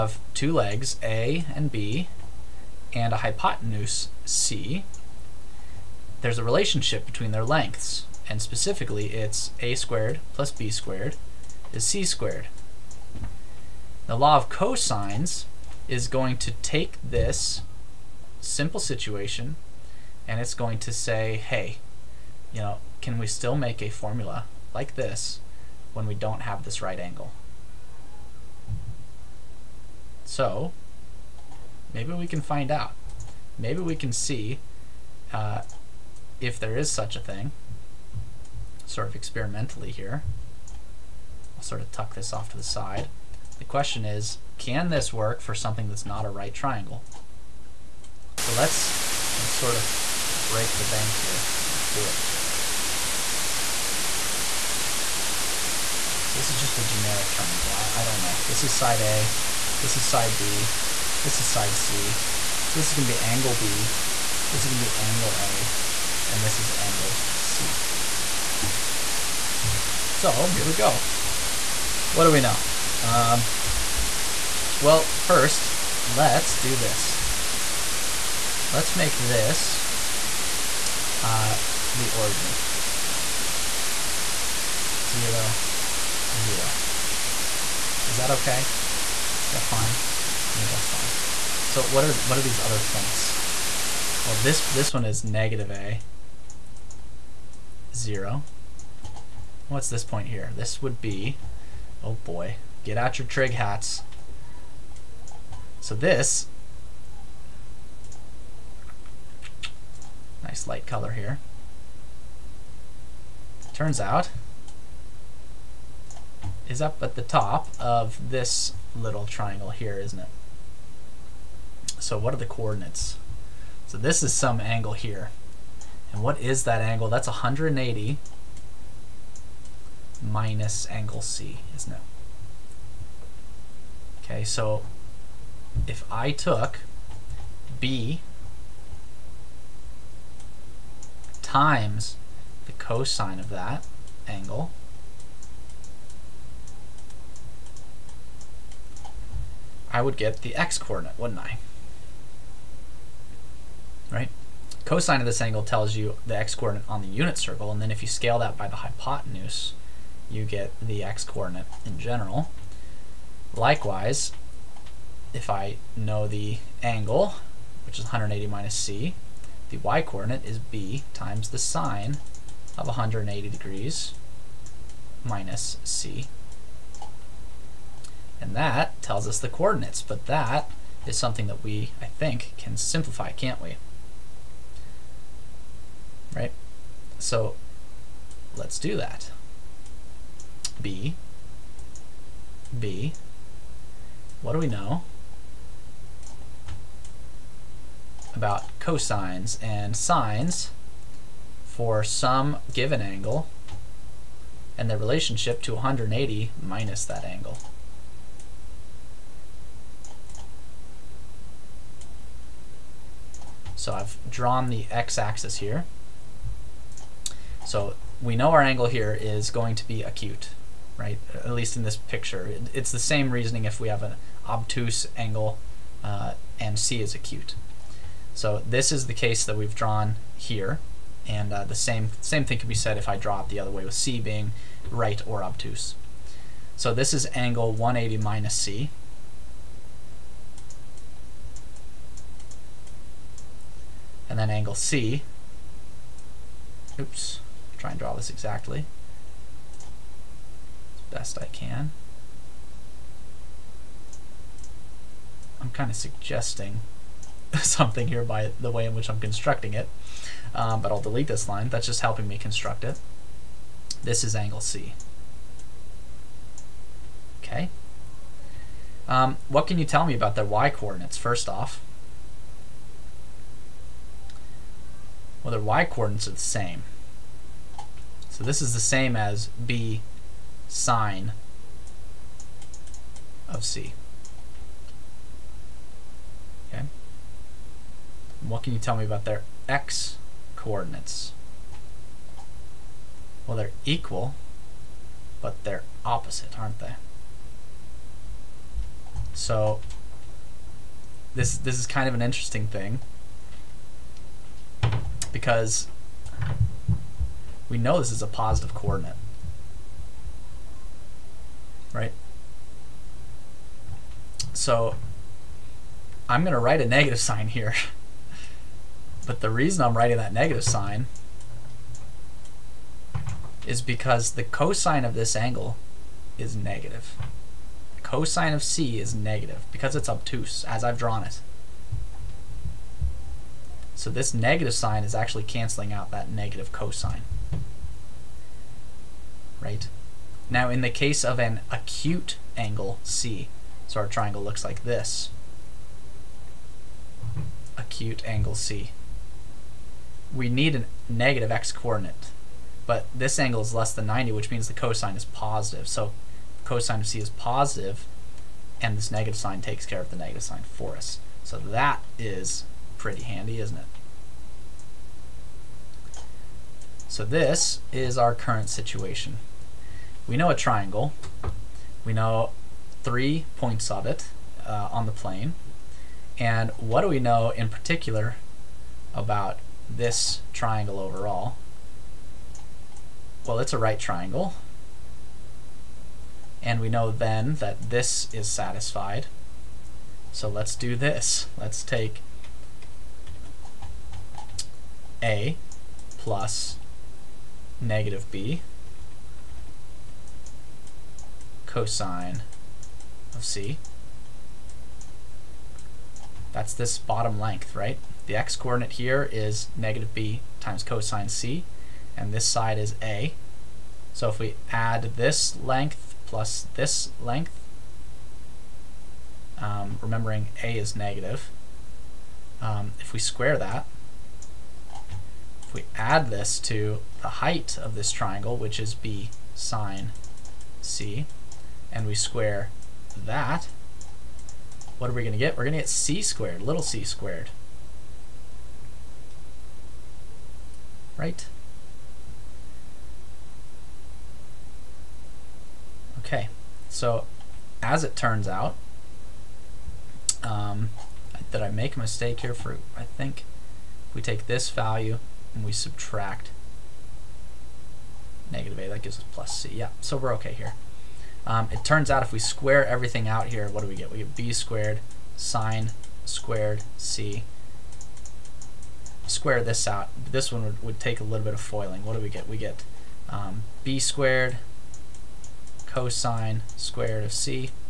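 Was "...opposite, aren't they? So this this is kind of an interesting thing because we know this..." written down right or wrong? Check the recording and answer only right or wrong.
right.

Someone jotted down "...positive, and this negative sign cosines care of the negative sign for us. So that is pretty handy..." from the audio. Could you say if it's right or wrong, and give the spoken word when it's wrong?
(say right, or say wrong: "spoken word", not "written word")
wrong: "takes", not "cosines".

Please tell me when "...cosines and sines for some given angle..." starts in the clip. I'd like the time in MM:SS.
03:18.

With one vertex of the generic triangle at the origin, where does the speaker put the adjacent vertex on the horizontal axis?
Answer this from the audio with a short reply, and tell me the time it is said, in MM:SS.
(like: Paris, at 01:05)
(-a, 0), at 01:35.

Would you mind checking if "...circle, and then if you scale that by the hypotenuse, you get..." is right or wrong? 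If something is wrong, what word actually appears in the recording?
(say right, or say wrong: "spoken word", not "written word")
right.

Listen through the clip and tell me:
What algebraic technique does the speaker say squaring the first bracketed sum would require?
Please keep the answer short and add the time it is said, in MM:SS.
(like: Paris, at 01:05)
Foiling, at 07:51.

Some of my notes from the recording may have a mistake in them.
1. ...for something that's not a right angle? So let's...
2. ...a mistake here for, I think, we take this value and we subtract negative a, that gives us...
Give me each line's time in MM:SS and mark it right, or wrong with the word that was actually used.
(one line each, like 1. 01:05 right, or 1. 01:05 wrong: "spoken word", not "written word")
1. 00:45 wrong: "triangle", not "angle"
2. 07:31 right.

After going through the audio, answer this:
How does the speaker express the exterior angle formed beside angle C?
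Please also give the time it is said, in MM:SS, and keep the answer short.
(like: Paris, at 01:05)
180 minus angle C, at 02:07.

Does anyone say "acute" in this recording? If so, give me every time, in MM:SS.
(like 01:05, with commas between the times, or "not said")
03:40, 03:47, 05:41, 05:47.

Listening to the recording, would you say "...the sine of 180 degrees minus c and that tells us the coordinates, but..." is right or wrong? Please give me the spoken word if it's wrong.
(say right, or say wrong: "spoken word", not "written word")
right.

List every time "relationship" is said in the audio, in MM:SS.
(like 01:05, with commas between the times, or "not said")
00:06, 03:24.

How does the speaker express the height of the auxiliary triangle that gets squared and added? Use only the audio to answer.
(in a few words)
b sine c.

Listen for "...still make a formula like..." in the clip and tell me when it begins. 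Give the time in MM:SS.
00:23.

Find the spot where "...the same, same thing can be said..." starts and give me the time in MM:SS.
03:51.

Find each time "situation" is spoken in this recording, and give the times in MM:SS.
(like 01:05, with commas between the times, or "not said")
00:18, 06:08.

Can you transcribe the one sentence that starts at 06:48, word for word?
The x-coordinate here is negative b times cosine c, and this side is a.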